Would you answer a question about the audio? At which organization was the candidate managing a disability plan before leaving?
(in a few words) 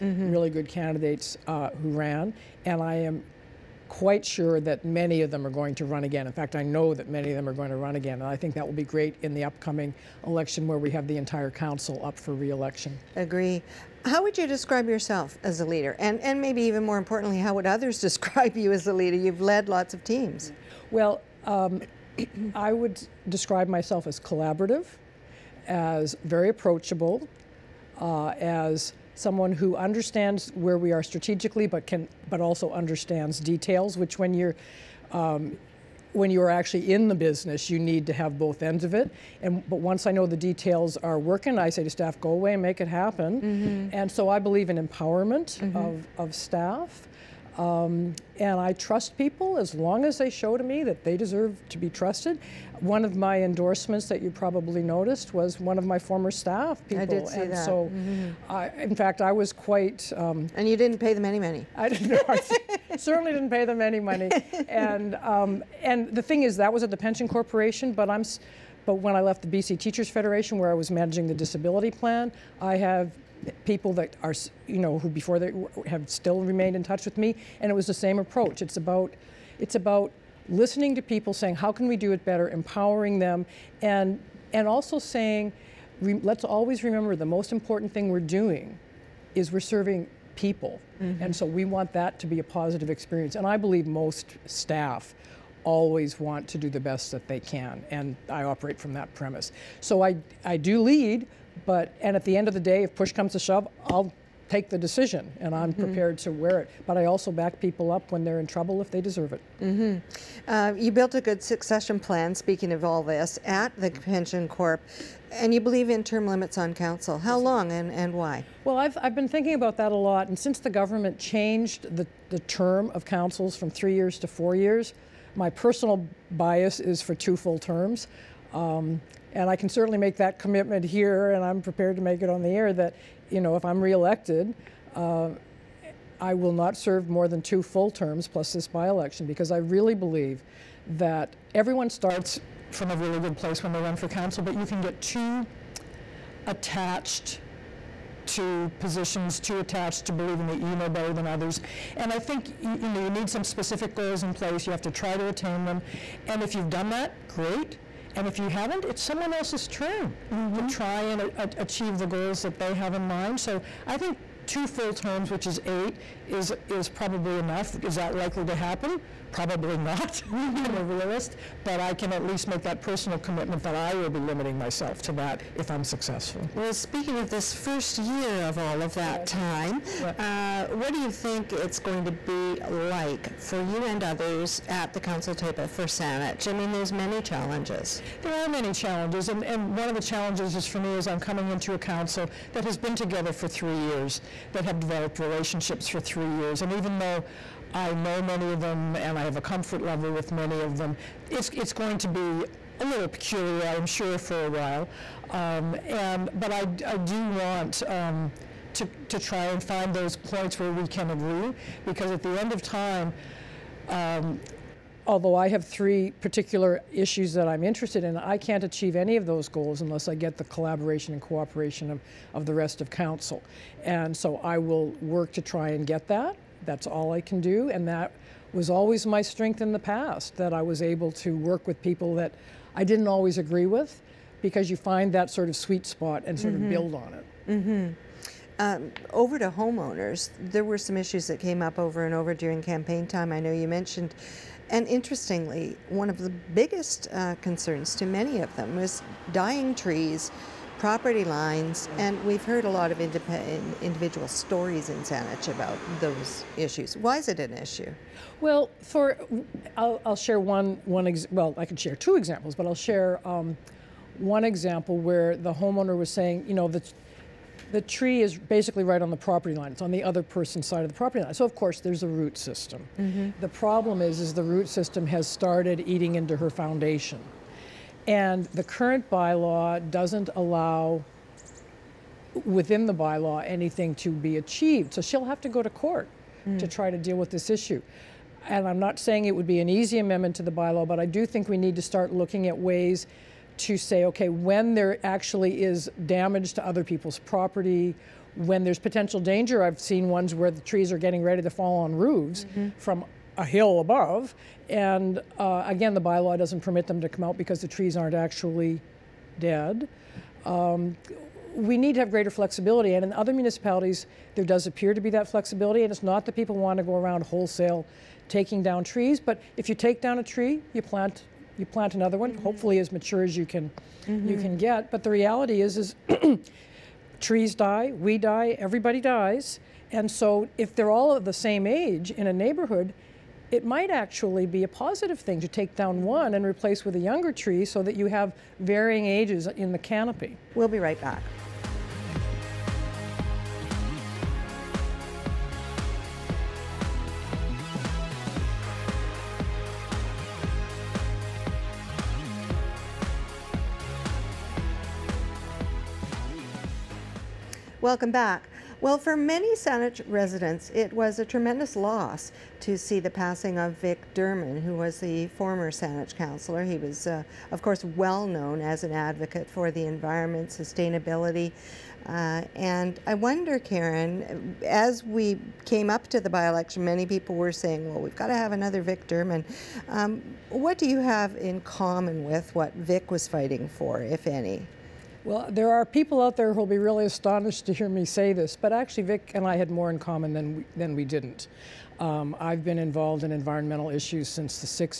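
BC Teachers Federation.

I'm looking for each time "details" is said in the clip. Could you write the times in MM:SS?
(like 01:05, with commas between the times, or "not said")
00:33, 00:40.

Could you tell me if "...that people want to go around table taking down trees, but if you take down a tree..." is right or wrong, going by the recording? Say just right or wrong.
wrong.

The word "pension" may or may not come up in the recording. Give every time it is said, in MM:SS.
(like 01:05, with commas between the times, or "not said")
01:06, 01:54.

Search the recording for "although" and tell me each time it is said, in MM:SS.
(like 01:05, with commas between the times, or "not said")
03:35.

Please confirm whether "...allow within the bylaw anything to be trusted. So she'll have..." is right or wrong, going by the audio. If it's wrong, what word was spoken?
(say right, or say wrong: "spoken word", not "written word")
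wrong: "achieved", not "trusted".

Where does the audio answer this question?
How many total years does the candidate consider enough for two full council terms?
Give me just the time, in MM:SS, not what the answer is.
02:45.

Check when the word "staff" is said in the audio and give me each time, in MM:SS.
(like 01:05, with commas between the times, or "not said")
00:41, 00:46, 00:56, 01:34.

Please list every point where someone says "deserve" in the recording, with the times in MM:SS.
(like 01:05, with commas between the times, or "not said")
00:51, 01:49.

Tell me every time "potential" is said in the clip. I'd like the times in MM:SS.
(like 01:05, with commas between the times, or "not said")
04:58.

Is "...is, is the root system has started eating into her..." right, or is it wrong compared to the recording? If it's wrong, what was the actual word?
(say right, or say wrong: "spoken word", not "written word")
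right.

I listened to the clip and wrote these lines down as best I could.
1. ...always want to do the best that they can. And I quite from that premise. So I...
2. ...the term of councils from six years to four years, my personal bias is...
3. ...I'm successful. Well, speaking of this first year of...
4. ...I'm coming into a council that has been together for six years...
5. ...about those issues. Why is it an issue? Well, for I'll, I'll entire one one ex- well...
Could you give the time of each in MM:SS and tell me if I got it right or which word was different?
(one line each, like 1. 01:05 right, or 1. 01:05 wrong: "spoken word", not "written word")
1. 01:35 wrong: "operate", not "quite"
2. 02:02 wrong: "three", not "six"
3. 02:55 right
4. 03:11 wrong: "three", not "six"
5. 04:15 wrong: "share", not "entire".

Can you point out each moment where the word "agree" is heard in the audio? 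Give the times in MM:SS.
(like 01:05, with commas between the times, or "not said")
00:13, 03:31, 03:53.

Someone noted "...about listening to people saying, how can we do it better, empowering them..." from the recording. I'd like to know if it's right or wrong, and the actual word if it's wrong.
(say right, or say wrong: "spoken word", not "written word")
right.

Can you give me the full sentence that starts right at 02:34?
You have to try to attain them.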